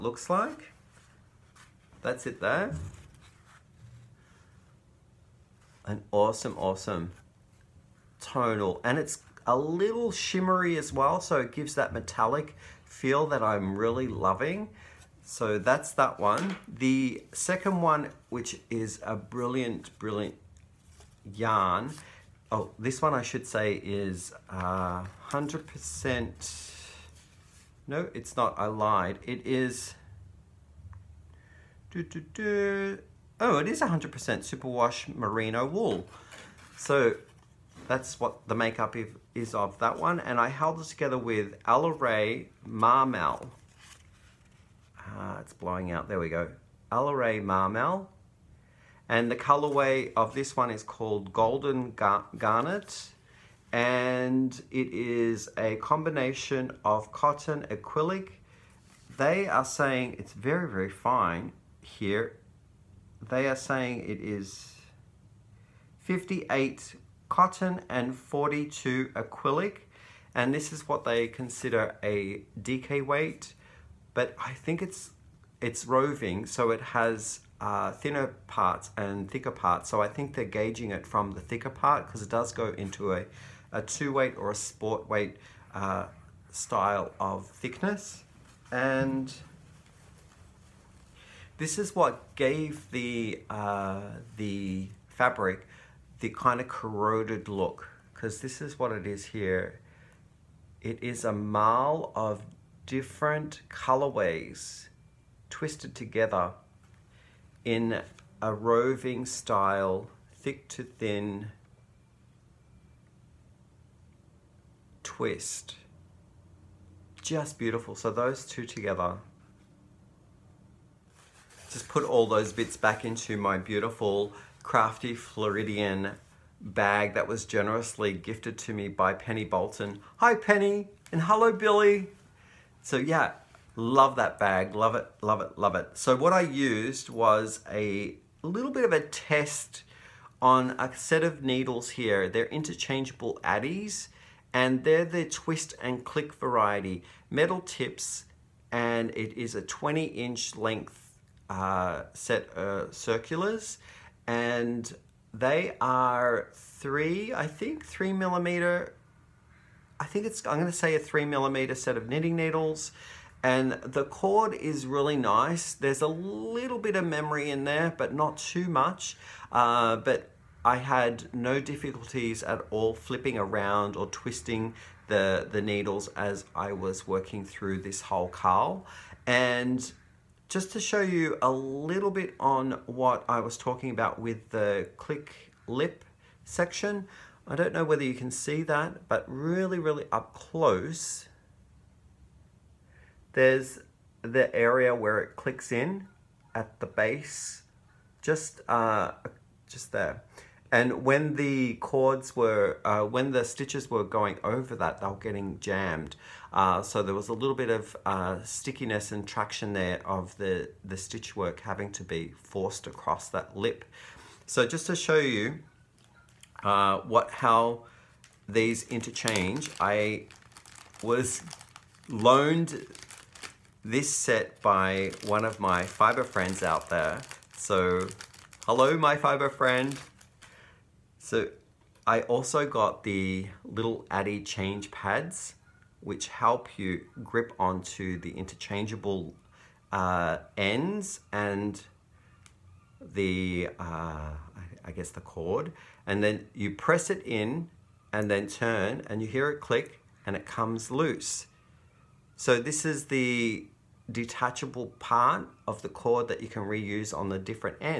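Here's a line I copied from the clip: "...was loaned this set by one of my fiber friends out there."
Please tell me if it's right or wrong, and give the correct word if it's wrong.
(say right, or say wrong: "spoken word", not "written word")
right.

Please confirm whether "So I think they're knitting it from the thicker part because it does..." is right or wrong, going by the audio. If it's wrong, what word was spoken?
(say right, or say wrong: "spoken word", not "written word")
wrong: "gauging", not "knitting".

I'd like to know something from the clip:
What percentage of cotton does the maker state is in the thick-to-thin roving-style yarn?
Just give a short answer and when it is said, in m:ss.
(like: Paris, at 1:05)
58, at 1:05.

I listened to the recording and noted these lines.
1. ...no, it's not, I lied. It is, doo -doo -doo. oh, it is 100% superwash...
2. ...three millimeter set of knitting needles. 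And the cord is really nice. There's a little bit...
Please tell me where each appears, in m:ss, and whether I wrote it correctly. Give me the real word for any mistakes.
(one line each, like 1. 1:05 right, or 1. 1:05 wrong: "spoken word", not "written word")
1. 0:27 right
2. 2:40 right.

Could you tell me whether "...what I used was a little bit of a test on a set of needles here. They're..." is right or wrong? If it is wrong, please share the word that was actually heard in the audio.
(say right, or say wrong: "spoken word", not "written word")
right.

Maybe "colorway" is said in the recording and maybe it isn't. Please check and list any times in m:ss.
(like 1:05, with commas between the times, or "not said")
0:49, 1:43.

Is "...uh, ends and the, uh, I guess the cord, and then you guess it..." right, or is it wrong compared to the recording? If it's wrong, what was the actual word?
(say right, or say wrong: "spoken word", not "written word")
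wrong: "press", not "guess".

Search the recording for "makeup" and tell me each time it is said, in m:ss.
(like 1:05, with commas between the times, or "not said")
0:38.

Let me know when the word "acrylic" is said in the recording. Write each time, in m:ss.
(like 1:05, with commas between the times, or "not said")
0:57, 1:09.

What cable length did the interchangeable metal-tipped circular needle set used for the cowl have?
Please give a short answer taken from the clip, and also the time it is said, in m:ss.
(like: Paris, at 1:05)
20 inch, at 2:29.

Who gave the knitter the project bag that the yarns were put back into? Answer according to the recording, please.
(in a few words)
Penny Bolton.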